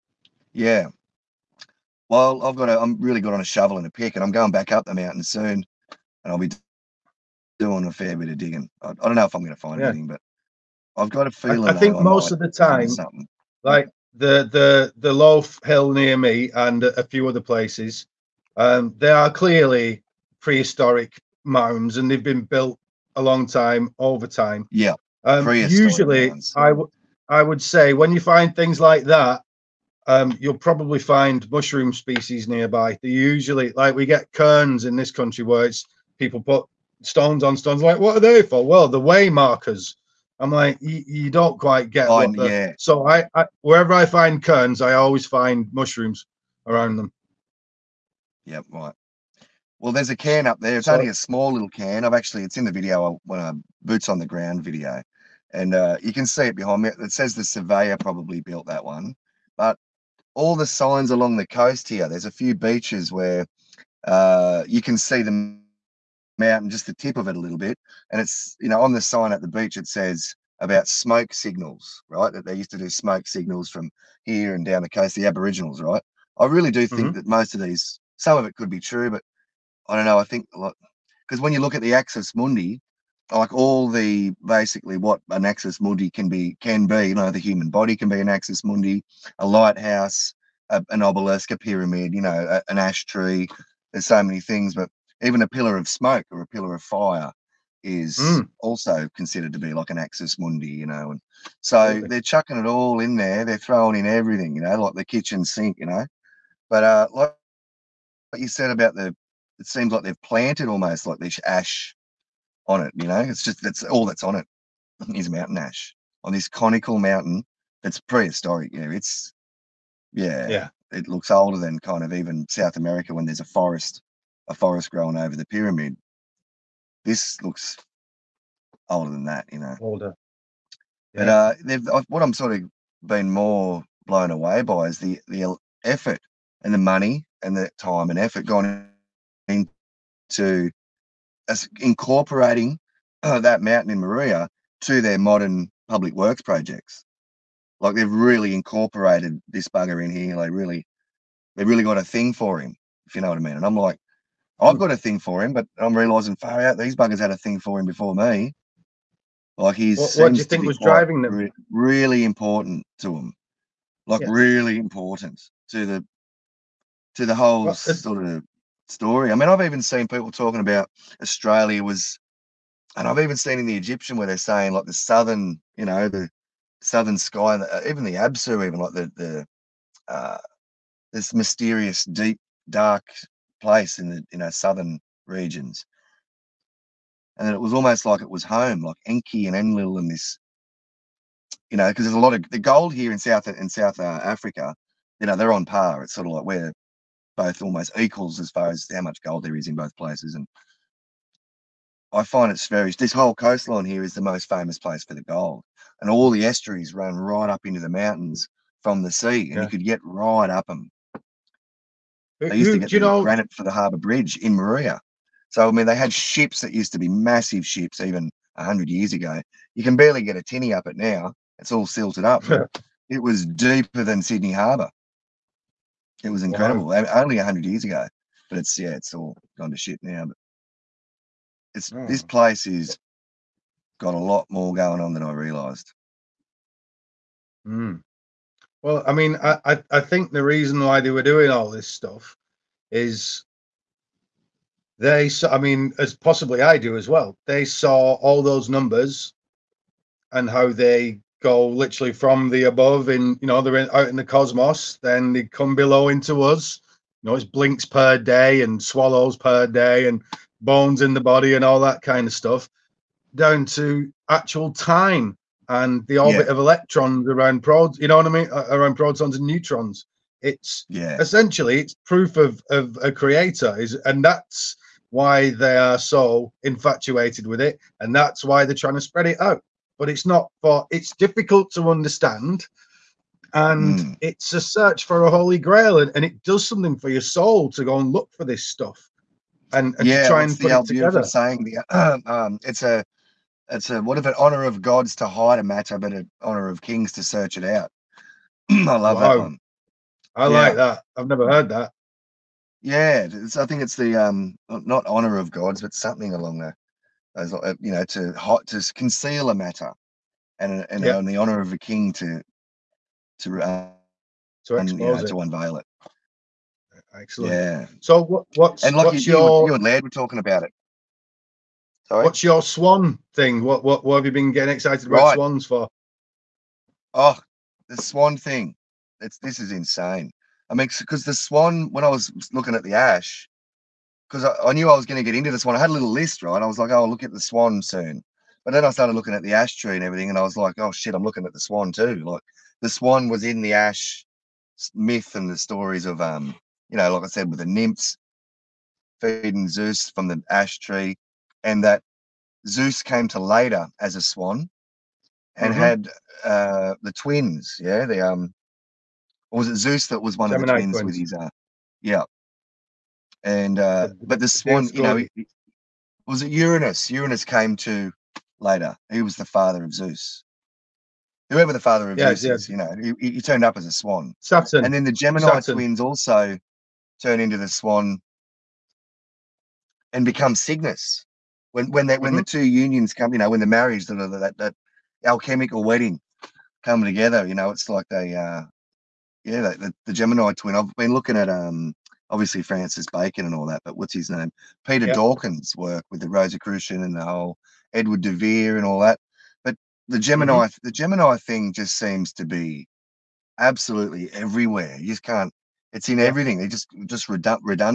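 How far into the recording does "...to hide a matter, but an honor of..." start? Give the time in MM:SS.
04:55.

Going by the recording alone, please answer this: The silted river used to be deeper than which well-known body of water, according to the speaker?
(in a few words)
Sydney Harbour.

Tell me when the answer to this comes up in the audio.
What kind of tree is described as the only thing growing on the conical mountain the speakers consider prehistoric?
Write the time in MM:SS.
01:55.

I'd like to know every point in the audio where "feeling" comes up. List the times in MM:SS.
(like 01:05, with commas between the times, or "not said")
00:11.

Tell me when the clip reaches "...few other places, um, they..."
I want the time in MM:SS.
00:17.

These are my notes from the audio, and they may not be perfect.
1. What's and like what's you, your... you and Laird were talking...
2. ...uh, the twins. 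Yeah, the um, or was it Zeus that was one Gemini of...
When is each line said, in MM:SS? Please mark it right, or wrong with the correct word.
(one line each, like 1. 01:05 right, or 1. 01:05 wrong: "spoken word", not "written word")
1. 05:18 right
2. 05:56 right.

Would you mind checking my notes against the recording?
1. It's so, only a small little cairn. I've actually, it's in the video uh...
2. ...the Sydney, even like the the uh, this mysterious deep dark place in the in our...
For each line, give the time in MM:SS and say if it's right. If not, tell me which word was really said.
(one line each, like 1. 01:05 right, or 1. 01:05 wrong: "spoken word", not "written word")
1. 00:50 right
2. 02:58 wrong: "Absu", not "Sydney".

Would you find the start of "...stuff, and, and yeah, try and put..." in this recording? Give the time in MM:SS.
04:48.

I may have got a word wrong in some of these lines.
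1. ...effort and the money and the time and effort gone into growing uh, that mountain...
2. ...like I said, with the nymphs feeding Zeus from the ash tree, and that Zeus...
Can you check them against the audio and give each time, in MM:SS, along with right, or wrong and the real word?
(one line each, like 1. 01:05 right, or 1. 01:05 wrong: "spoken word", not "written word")
1. 02:15 wrong: "incorporating", not "growing"
2. 05:47 right.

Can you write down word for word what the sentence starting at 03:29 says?
you could get right up them.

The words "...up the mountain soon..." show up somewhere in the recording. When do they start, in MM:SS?
00:04.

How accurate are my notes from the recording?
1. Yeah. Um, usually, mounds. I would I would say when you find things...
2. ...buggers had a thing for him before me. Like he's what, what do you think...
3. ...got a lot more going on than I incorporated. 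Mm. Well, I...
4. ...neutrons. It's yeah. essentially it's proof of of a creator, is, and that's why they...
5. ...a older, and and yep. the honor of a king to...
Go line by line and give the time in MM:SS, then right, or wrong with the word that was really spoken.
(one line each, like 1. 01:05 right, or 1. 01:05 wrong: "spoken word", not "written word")
1. 00:24 right
2. 02:36 right
3. 03:53 wrong: "realised", not "incorporated"
4. 04:29 right
5. 05:09 wrong: "matter", not "older".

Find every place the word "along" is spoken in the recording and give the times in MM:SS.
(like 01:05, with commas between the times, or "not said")
01:01, 05:06.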